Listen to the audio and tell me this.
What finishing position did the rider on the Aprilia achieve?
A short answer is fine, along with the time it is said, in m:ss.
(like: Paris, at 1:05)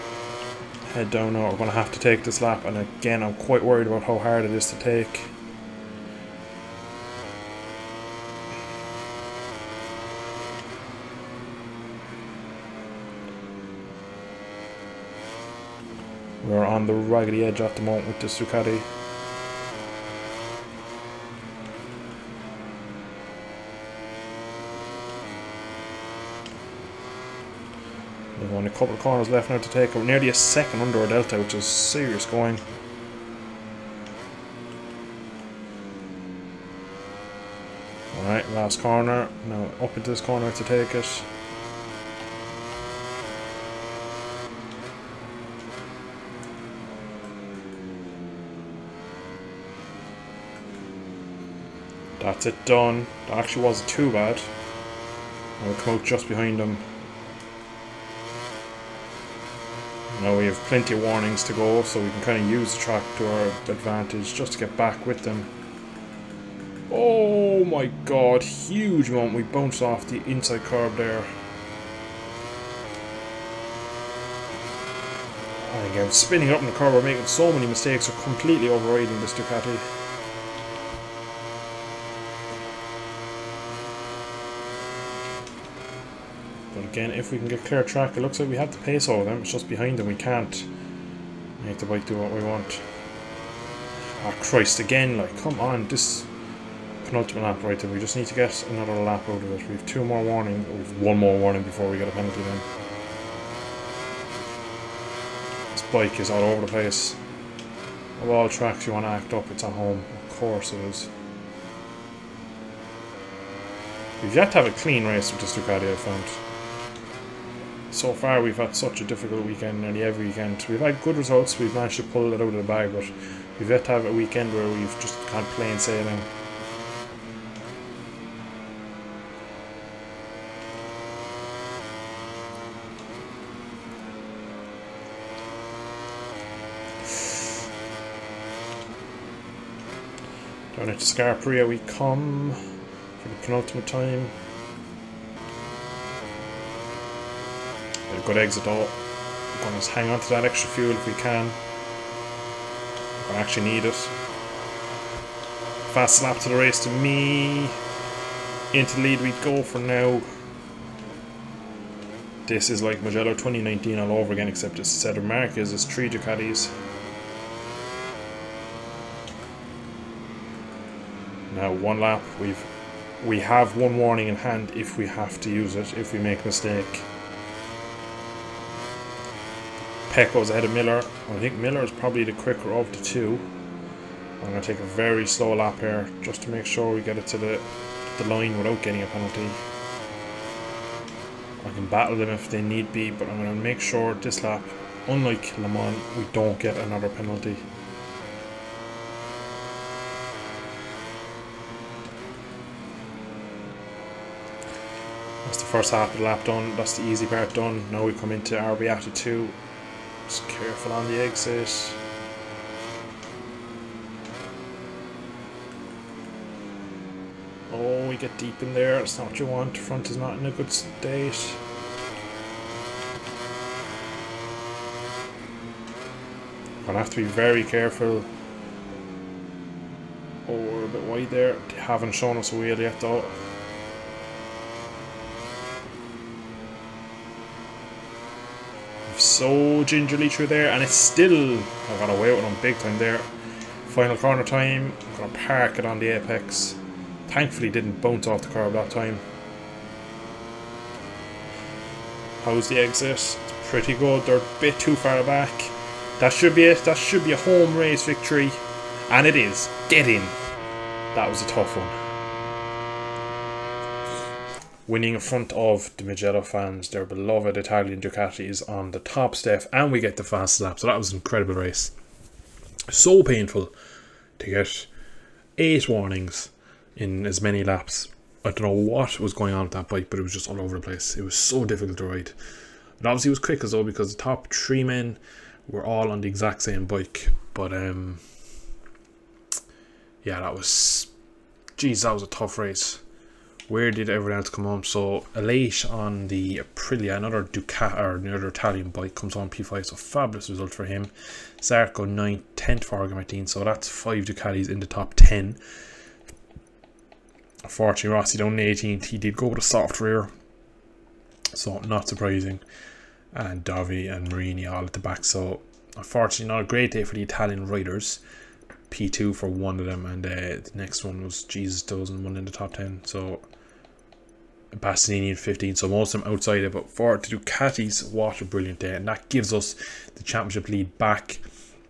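5th, at 4:59.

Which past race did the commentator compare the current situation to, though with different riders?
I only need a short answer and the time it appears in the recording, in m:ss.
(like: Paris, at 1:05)
Mugello 2019, at 2:43.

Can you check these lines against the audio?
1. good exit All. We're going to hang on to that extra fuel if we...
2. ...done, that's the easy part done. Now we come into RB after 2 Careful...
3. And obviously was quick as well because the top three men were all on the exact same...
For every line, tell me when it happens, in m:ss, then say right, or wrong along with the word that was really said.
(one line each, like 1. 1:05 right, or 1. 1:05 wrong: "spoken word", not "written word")
1. 2:28 right
2. 3:26 right
3. 4:42 right.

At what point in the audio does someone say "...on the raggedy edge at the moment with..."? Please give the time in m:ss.
0:16.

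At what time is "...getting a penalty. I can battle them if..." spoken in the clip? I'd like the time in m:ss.
3:08.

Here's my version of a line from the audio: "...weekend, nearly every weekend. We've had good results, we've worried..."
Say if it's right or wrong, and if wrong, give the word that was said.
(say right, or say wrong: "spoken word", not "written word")
wrong: "managed", not "worried".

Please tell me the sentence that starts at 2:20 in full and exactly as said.
Down into Scarperia we come for the penultimate time.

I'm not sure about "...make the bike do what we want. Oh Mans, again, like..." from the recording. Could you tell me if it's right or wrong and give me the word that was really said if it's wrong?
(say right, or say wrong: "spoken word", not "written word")
wrong: "Christ", not "Mans".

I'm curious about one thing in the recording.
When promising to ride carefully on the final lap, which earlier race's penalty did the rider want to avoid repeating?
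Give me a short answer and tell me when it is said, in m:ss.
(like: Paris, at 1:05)
Le Mans, at 3:15.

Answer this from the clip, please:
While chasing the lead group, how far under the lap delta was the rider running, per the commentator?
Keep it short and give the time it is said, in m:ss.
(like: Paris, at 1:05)
nearly a second, at 0:30.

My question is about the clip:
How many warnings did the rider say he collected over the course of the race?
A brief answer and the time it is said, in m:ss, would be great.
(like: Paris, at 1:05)
8, at 4:35.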